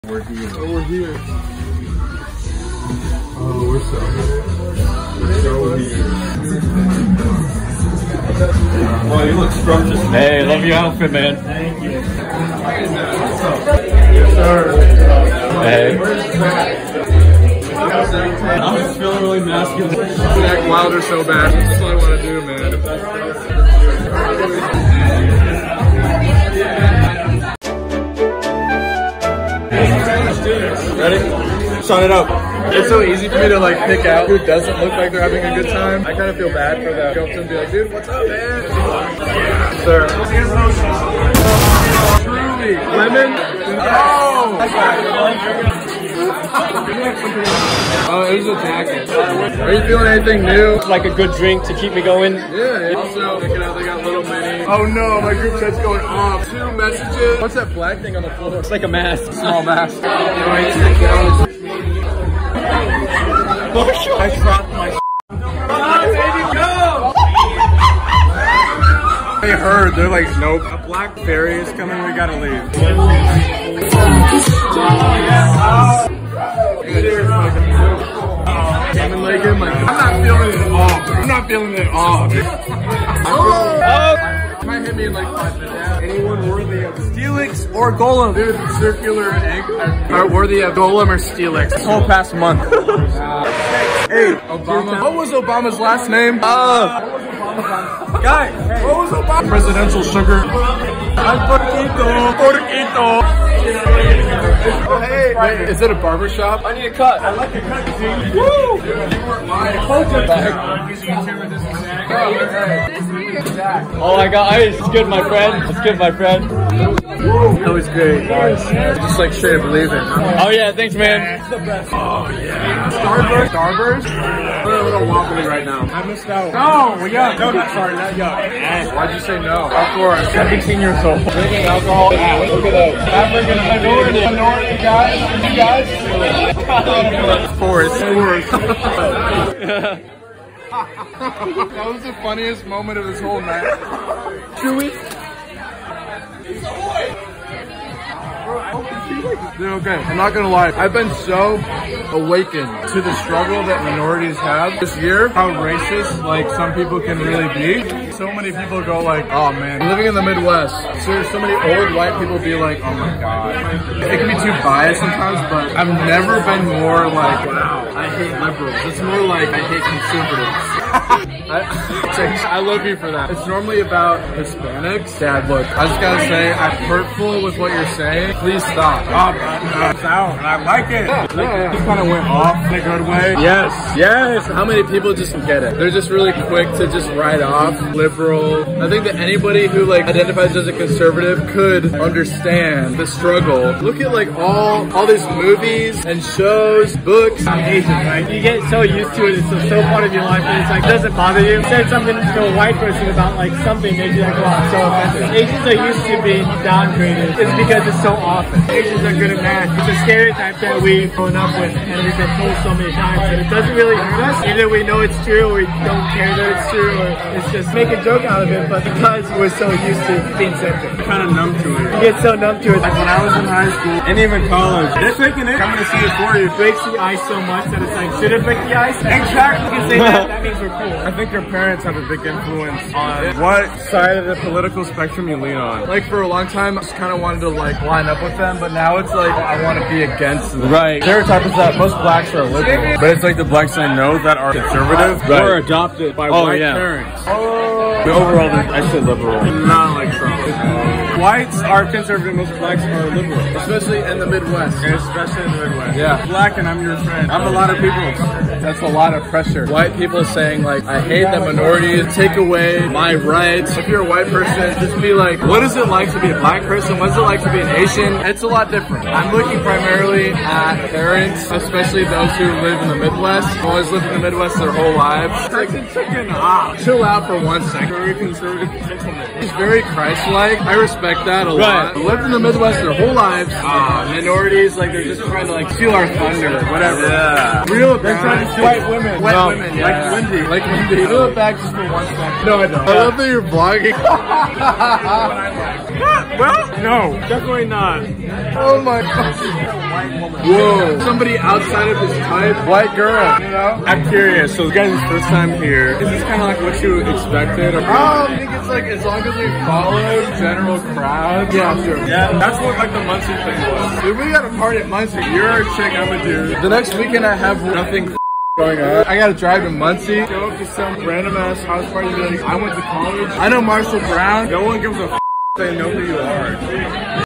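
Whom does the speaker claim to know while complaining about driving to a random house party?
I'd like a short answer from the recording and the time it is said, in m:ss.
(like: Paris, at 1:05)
Marshall Brown, at 5:23.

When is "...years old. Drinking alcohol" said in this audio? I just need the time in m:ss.
2:10.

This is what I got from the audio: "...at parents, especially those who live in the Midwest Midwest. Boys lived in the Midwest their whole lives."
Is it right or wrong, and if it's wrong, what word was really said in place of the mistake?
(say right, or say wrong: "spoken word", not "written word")
right.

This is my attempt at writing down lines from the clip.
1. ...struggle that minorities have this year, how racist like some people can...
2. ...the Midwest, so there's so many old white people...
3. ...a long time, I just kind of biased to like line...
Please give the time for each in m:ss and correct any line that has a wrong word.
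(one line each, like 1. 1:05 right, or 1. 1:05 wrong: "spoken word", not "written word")
1. 2:33 right
2. 2:40 right
3. 3:56 wrong: "wanted", not "biased".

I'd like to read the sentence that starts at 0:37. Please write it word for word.
Go up to them and be like, dude, what's up, man?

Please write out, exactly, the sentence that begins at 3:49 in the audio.
You say that, that means we're cool.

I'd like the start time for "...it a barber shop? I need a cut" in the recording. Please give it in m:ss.
1:45.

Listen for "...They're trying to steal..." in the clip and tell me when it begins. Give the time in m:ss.
4:48.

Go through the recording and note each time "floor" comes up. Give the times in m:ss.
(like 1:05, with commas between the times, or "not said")
0:58.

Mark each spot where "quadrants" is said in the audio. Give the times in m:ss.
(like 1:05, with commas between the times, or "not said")
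not said.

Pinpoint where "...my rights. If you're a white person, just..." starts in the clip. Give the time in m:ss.
4:22.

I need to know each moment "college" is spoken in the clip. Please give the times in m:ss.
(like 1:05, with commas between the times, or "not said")
3:44, 5:22.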